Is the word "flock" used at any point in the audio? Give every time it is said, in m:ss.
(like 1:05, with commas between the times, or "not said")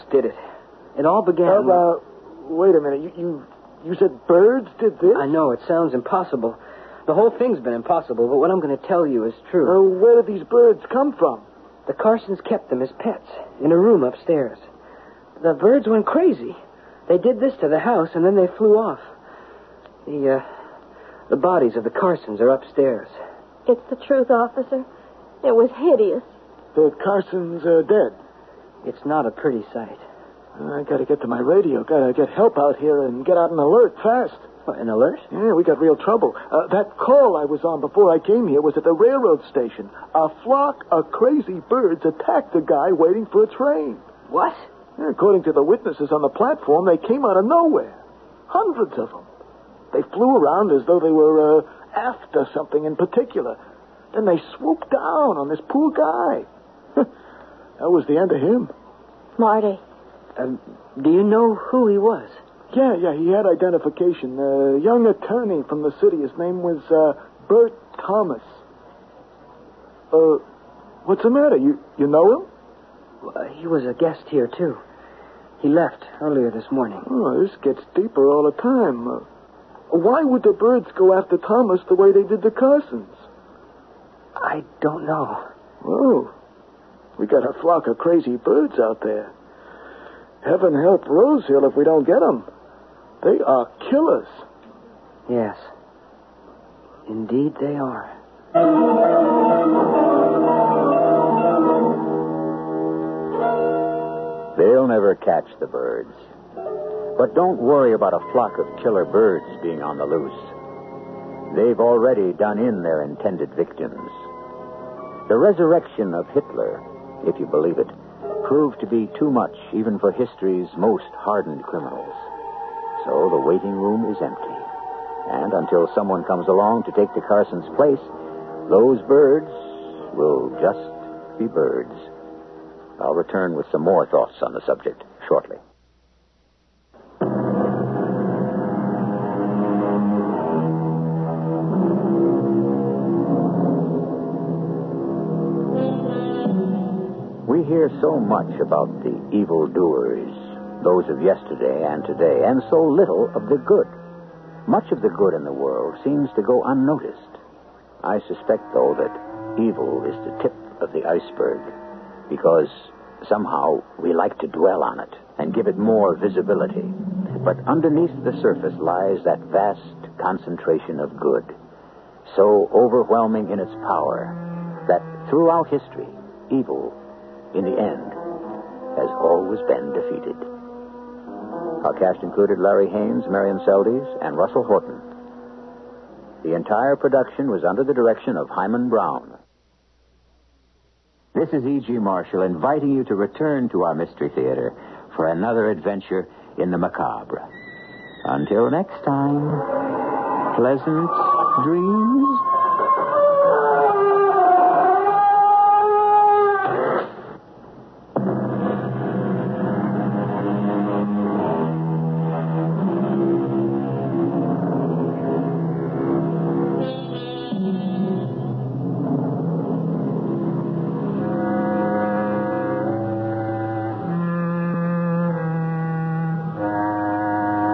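0:40, 1:27, 1:48.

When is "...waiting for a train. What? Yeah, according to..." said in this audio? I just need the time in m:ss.
0:42.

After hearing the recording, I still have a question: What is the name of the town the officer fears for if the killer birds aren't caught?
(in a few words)
Rose Hill.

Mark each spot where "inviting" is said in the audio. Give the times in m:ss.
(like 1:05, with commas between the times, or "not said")
3:12.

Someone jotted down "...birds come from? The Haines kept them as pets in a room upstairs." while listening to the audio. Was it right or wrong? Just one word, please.
wrong.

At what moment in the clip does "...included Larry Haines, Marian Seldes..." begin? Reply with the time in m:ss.
3:02.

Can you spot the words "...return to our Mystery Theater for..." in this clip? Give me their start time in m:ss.
3:13.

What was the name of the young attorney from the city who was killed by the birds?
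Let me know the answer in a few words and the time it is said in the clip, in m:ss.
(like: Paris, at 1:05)
Bert Thomas, at 1:07.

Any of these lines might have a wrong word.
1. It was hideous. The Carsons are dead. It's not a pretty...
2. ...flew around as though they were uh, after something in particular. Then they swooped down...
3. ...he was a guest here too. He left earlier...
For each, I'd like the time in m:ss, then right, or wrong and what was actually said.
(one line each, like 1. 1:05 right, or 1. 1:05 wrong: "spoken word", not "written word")
1. 0:25 right
2. 0:50 right
3. 1:13 right.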